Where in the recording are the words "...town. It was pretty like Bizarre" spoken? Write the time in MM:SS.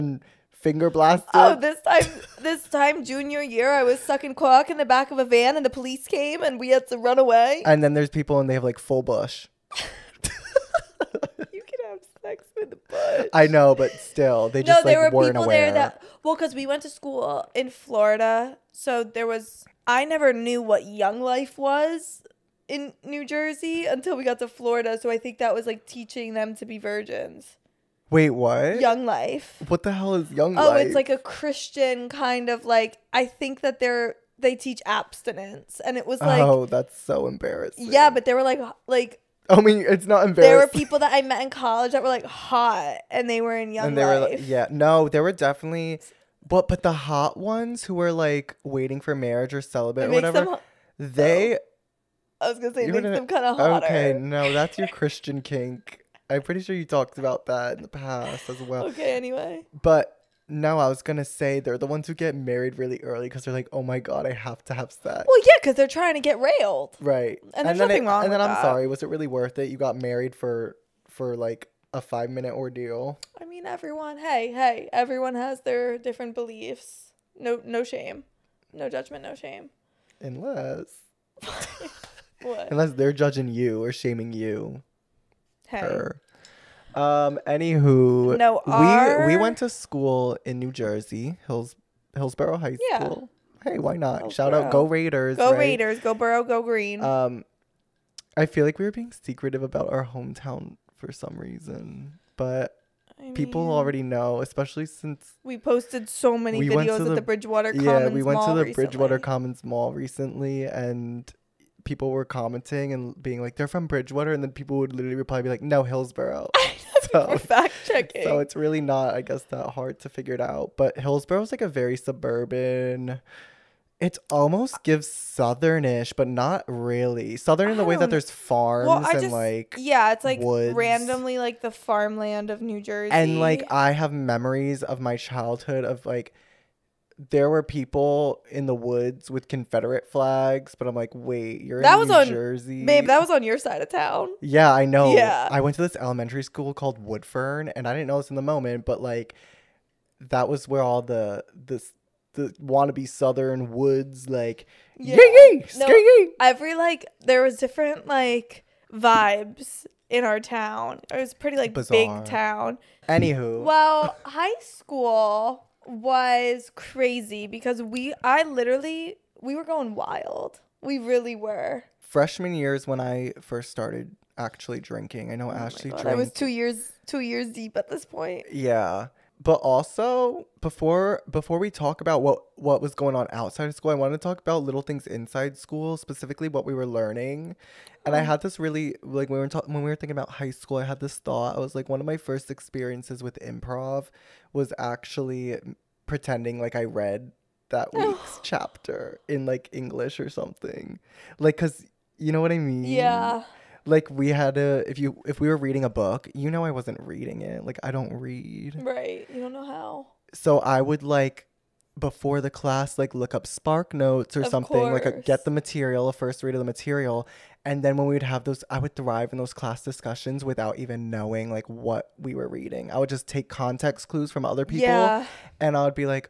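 02:40.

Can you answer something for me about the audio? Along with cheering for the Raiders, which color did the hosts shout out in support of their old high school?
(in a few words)
Green.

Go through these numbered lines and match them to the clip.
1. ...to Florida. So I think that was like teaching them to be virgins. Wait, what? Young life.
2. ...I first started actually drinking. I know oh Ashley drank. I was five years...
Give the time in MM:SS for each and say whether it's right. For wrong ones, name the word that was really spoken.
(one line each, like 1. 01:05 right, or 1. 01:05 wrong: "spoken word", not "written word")
1. 00:24 right
2. 02:52 wrong: "two", not "five".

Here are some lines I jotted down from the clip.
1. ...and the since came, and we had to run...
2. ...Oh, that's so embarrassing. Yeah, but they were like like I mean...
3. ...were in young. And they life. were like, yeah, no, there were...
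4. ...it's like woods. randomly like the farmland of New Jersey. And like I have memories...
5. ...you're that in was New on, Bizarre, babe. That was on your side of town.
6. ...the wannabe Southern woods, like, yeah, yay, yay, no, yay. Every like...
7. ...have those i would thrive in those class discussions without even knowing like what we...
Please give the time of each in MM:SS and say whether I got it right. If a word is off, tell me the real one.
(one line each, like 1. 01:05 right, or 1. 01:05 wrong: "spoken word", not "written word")
1. 00:05 wrong: "police", not "since"
2. 00:36 right
3. 00:43 right
4. 02:10 right
5. 02:21 wrong: "Jersey", not "Bizarre"
6. 02:32 right
7. 03:38 right.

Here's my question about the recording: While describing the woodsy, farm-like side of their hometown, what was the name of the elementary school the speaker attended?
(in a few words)
Woodfern.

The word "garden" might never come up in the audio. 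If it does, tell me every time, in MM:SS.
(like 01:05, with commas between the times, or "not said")
not said.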